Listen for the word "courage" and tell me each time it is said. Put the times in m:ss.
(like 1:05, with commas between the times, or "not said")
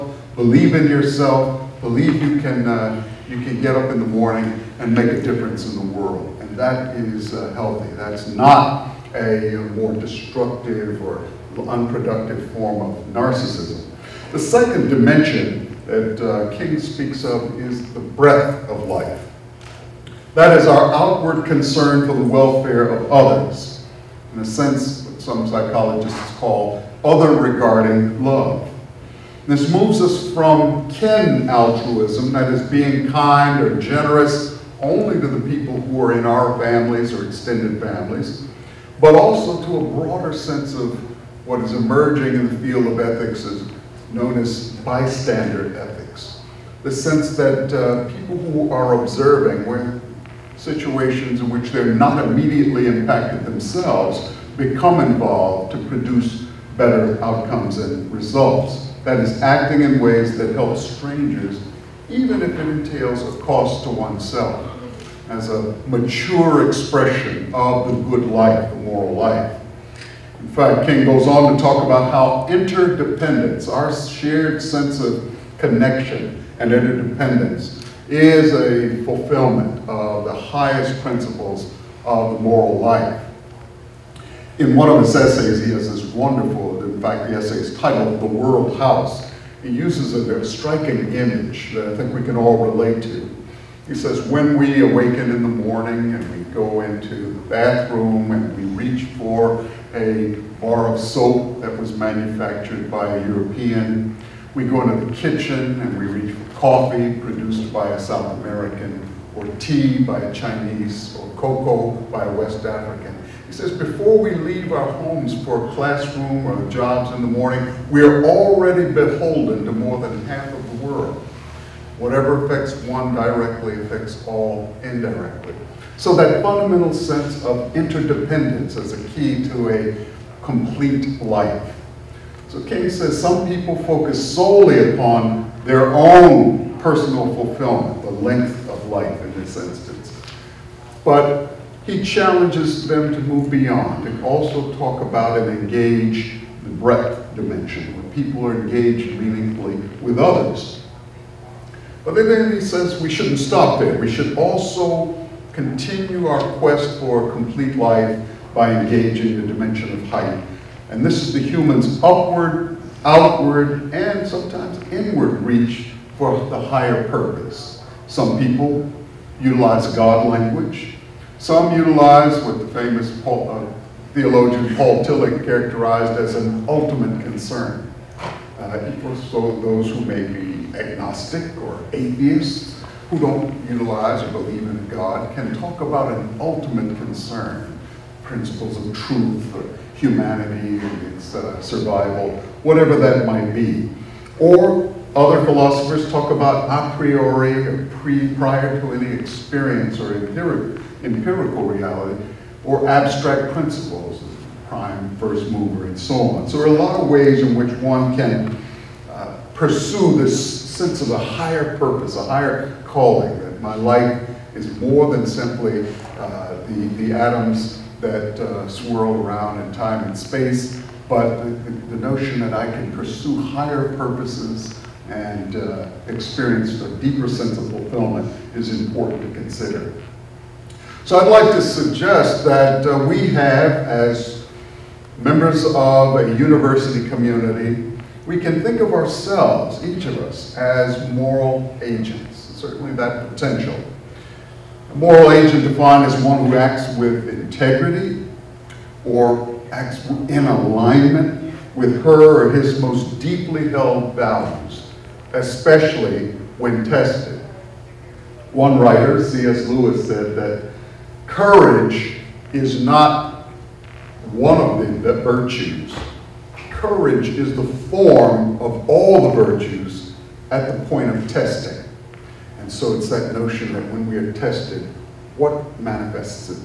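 4:21, 4:26.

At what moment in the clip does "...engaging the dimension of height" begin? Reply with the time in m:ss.
2:38.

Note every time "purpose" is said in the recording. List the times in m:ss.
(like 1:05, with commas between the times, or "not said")
2:47, 3:31, 3:43.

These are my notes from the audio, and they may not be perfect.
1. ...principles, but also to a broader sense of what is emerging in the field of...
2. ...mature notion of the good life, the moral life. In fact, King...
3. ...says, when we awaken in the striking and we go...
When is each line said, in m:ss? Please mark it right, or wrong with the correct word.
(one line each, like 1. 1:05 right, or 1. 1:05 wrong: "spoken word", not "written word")
1. 0:37 wrong: "families", not "principles"
2. 1:05 wrong: "expression", not "notion"
3. 1:33 wrong: "morning", not "striking".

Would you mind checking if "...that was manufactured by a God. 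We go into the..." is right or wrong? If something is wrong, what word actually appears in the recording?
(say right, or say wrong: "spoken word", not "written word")
wrong: "European", not "God".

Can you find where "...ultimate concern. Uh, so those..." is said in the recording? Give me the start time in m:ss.
2:56.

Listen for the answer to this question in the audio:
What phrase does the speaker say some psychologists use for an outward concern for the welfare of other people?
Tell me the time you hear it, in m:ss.
0:27.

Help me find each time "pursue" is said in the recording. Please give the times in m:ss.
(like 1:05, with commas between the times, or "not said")
3:29, 3:42.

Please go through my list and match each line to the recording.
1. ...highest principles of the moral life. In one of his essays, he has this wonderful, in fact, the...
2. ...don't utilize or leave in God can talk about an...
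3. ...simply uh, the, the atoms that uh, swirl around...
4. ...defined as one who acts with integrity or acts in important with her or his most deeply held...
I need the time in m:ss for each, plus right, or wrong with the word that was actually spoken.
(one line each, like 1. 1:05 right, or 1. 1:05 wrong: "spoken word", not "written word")
1. 1:20 right
2. 3:03 wrong: "believe", not "leave"
3. 3:35 right
4. 4:05 wrong: "alignment", not "important".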